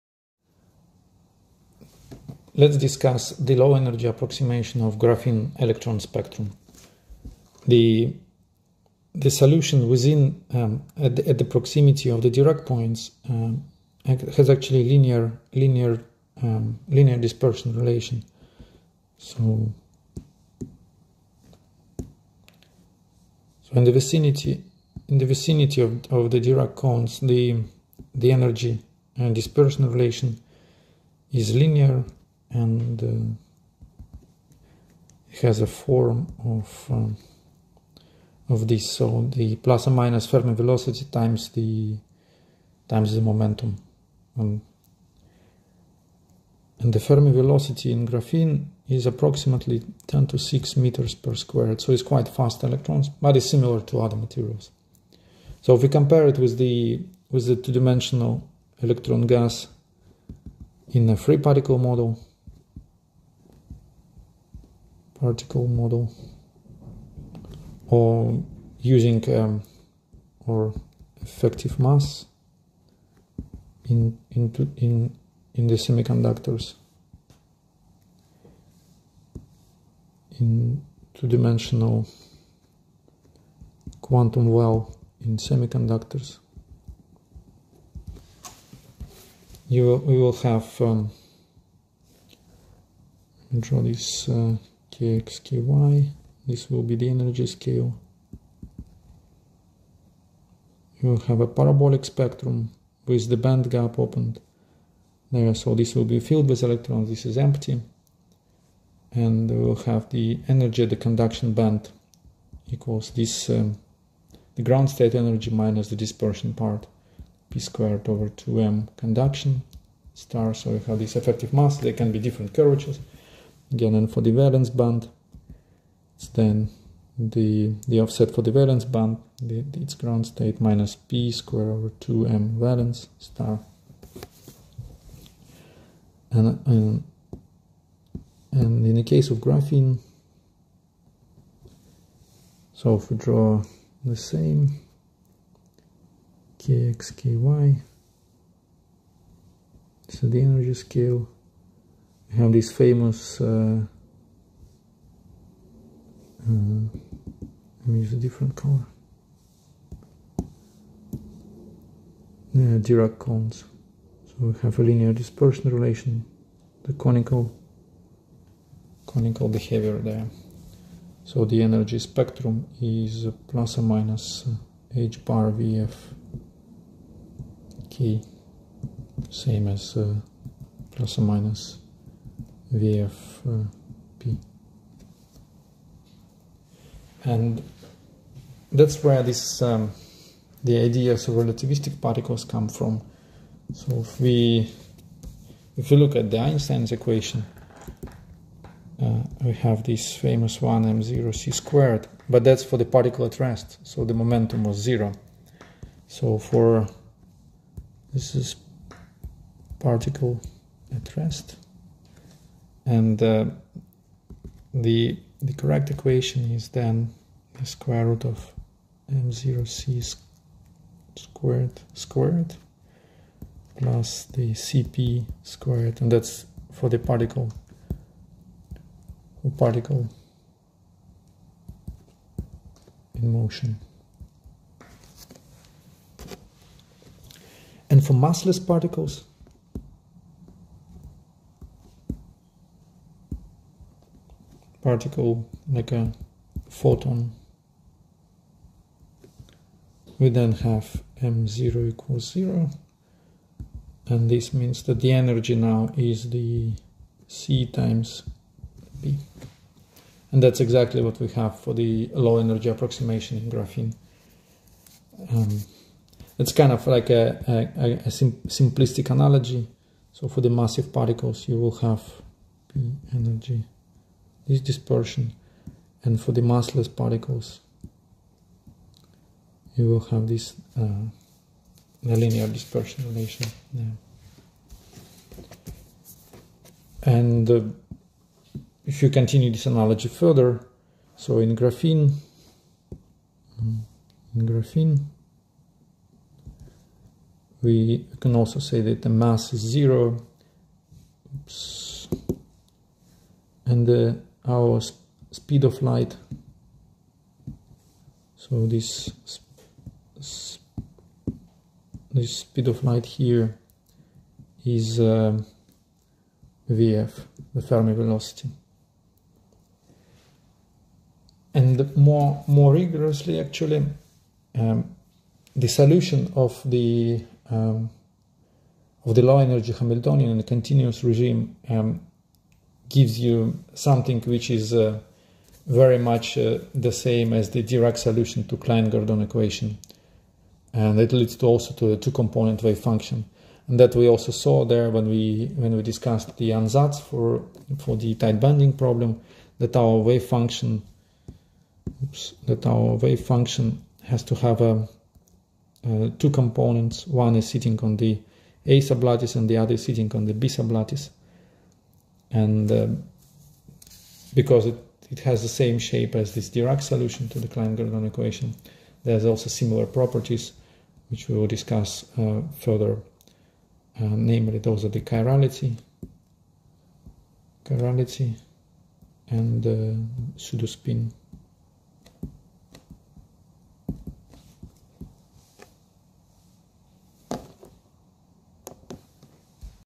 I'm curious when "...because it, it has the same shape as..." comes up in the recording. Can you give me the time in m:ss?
6:04.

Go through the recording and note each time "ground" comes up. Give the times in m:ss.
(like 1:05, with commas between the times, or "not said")
1:54, 2:09.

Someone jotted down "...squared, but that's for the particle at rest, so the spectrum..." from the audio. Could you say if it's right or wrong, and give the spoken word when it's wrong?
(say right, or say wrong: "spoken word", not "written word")
wrong: "momentum", not "spectrum".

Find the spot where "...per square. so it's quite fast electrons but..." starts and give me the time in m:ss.
0:51.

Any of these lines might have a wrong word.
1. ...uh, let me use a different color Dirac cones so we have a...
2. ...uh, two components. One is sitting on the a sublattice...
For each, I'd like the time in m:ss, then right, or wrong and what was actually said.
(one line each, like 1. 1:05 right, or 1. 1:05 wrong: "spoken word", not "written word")
1. 2:36 right
2. 5:56 right.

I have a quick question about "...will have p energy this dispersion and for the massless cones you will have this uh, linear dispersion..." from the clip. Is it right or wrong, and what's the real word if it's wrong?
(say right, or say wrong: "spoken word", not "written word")
wrong: "particles", not "cones".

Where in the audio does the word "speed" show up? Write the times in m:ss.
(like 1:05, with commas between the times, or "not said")
5:05, 5:12.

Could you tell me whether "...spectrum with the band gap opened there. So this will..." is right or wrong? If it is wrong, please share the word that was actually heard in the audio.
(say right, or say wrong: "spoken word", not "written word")
right.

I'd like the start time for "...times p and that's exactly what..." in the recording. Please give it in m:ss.
4:17.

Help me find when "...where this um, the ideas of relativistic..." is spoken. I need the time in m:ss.
3:09.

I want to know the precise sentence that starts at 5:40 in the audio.
And it leads to also to a two-component wave function.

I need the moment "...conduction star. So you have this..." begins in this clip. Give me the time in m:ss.
1:58.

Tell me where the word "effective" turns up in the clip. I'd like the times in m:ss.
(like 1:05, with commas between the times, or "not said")
1:11, 2:01.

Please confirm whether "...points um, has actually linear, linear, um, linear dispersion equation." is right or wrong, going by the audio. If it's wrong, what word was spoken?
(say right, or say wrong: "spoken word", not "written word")
wrong: "relation", not "equation".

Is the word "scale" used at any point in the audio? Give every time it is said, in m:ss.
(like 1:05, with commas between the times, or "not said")
1:37, 2:30.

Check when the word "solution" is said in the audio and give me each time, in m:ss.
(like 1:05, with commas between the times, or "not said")
0:09, 5:25, 5:37, 6:06.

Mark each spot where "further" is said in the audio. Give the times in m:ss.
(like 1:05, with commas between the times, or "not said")
4:50, 6:12.